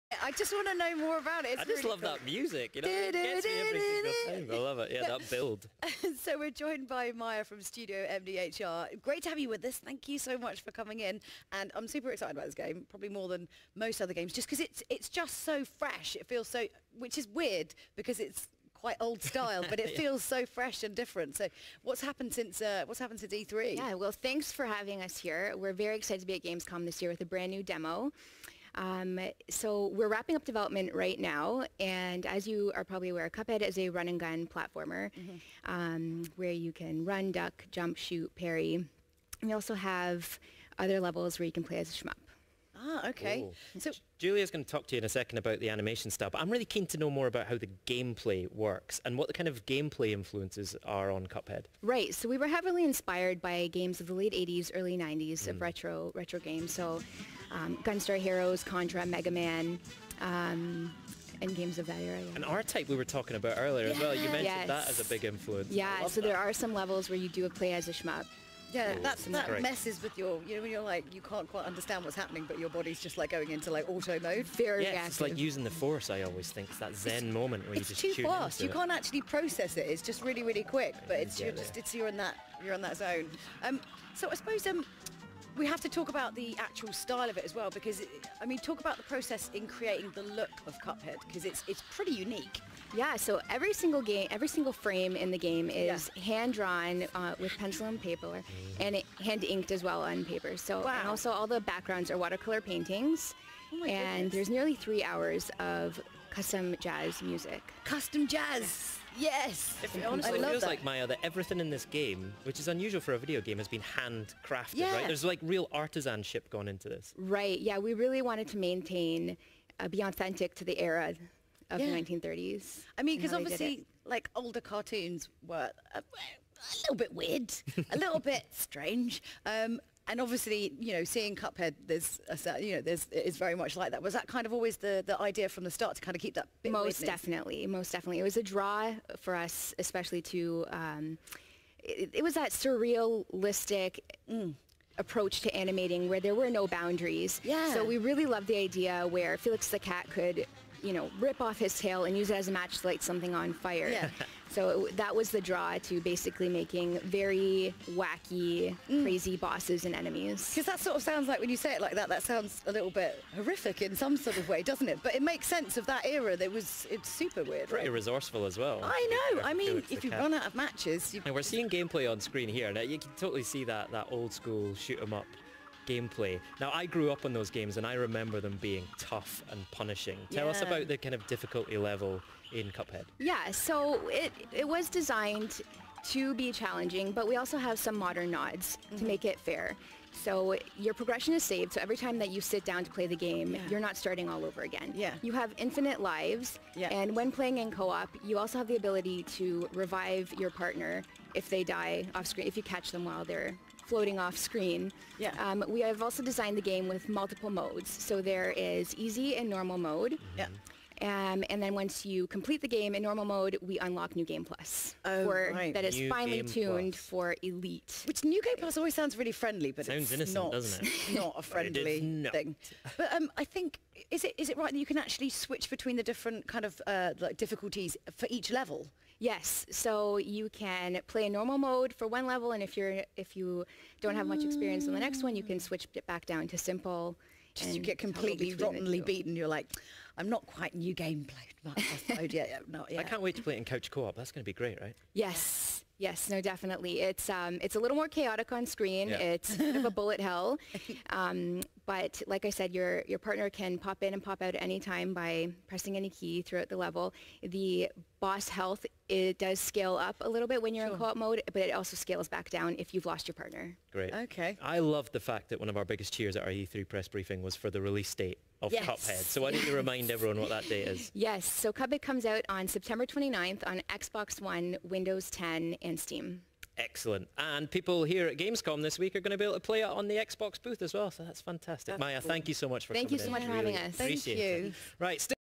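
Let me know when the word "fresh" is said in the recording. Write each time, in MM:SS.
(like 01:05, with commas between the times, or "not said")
00:15, 00:20.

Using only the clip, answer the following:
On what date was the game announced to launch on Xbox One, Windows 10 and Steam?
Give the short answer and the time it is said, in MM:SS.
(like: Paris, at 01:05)
September 29th, at 04:32.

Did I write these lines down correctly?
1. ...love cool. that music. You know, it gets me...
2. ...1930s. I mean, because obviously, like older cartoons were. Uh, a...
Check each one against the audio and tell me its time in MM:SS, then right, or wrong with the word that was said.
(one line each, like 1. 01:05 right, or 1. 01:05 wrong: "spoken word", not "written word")
1. 00:01 right
2. 02:01 right.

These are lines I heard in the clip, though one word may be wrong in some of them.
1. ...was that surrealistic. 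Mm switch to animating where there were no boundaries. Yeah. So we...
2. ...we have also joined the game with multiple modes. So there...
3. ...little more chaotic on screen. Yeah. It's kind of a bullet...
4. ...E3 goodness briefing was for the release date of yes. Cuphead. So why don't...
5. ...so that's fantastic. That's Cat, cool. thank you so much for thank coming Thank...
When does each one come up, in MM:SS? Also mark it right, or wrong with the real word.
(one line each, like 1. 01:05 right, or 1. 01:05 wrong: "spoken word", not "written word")
1. 02:22 wrong: "approach", not "switch"
2. 03:25 wrong: "designed", not "joined"
3. 04:07 right
4. 04:26 wrong: "press", not "goodness"
5. 04:41 wrong: "Maya", not "Cat".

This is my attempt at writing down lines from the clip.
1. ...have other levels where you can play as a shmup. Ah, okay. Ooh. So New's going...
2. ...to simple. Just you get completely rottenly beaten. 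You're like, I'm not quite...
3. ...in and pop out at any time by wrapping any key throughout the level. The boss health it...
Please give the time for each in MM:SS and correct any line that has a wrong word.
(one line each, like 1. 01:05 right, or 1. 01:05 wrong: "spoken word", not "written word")
1. 00:39 wrong: "Julia", not "New"
2. 03:56 right
3. 04:14 wrong: "pressing", not "wrapping".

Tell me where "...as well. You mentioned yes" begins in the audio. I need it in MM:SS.
01:03.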